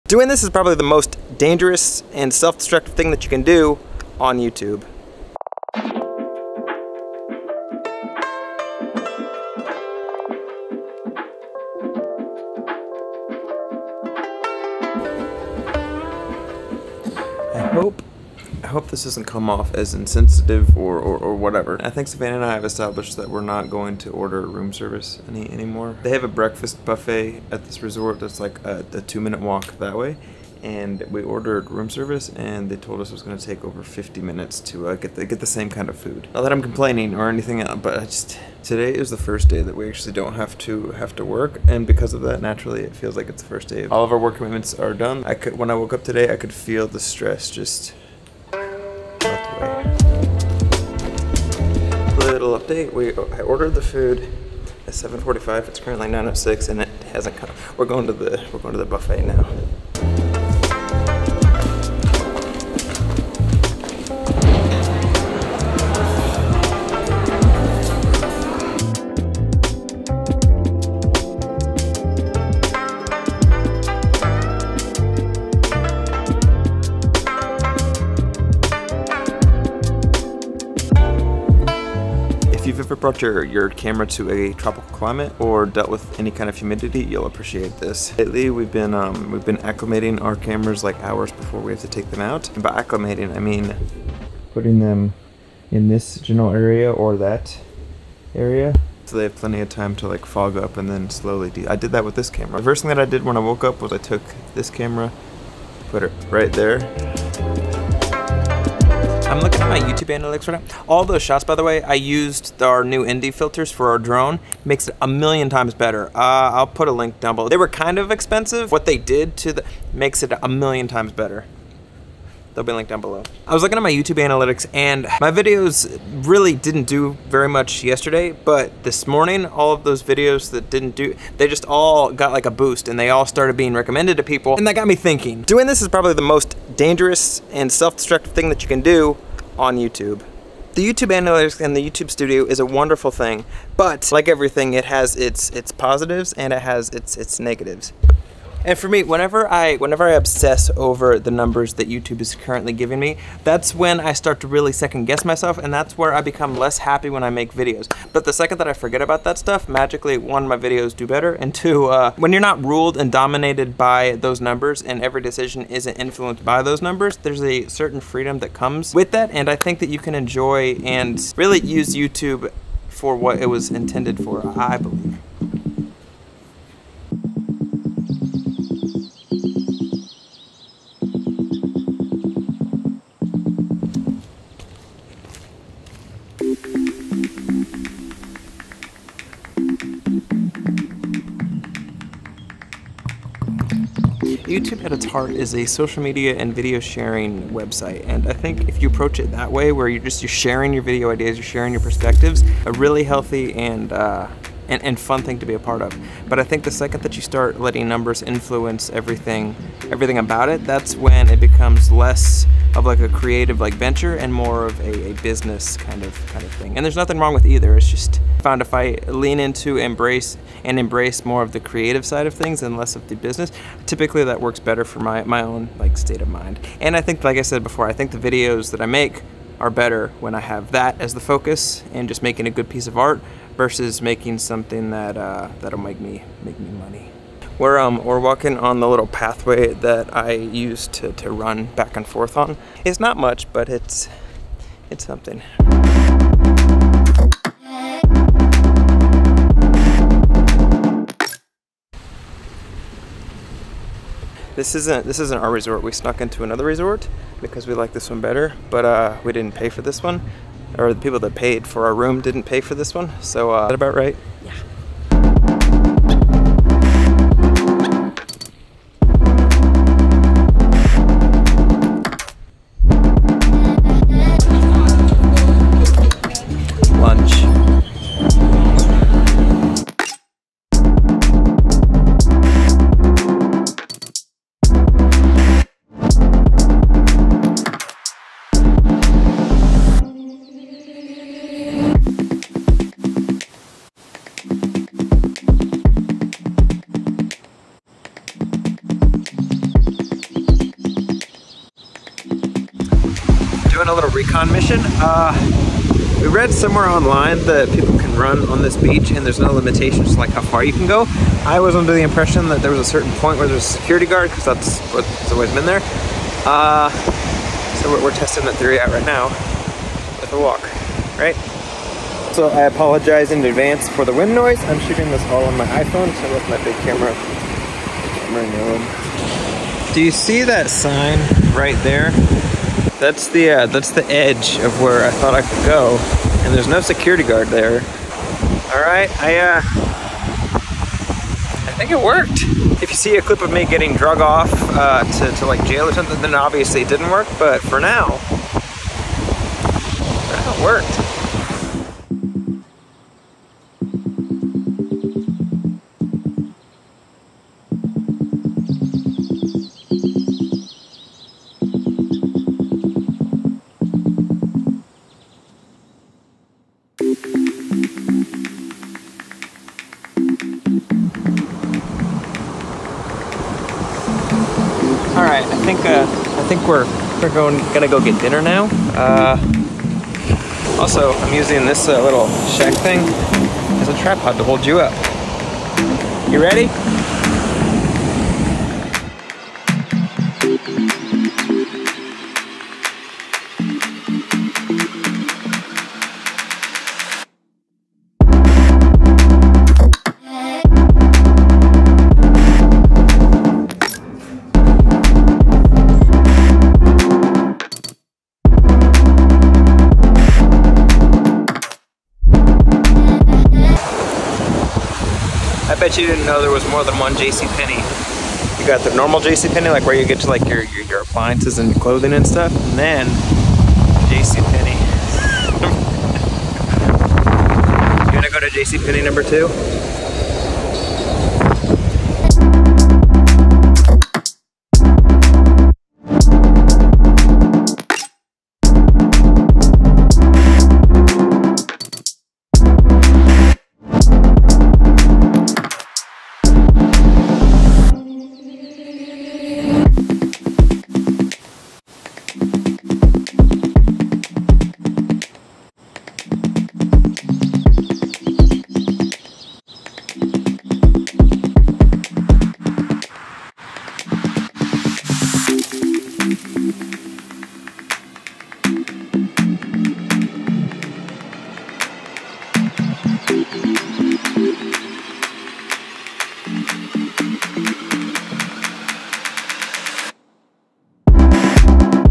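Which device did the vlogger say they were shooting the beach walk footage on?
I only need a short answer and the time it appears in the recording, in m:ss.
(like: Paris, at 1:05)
iPhone, at 5:25.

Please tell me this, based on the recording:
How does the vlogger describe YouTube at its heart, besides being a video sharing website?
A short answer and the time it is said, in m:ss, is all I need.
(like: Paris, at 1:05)
social media, at 3:15.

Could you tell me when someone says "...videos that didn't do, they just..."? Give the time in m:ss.
2:10.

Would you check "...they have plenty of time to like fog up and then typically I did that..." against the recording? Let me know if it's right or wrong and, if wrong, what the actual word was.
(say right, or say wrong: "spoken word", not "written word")
wrong: "slowly", not "typically".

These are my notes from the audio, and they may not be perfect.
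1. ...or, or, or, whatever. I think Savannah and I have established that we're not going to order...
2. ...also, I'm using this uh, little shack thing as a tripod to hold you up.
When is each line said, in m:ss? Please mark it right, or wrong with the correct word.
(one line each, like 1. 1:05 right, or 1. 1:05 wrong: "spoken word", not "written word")
1. 0:20 right
2. 6:20 right.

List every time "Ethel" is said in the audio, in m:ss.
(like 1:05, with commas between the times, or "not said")
not said.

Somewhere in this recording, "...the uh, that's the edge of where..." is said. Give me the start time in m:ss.
5:33.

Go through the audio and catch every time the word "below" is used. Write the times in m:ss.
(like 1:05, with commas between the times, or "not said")
1:57, 2:03.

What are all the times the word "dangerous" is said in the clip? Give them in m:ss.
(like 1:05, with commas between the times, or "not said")
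0:01, 2:16.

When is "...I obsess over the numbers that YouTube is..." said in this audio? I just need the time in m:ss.
2:30.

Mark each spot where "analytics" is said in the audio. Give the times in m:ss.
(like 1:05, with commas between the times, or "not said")
1:50, 2:04, 2:21.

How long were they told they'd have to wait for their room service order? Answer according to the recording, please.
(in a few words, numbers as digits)
over 50 minutes.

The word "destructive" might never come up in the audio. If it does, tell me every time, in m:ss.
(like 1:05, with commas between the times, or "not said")
0:02, 2:17.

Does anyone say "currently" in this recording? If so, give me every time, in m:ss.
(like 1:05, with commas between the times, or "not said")
0:55, 2:32.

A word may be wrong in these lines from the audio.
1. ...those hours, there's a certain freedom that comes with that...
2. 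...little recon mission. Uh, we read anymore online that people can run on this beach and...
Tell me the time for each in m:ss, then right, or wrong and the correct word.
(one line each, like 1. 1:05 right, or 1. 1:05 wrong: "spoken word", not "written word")
1. 2:46 wrong: "numbers", not "hours"
2. 5:03 wrong: "somewhere", not "anymore".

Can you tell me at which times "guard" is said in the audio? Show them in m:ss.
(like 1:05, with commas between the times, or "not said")
5:14, 5:37.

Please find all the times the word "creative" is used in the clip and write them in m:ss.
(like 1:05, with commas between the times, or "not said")
3:33, 3:41.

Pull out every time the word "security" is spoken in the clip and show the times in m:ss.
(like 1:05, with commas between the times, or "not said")
5:13, 5:36.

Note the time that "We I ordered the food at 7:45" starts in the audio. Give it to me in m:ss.
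0:52.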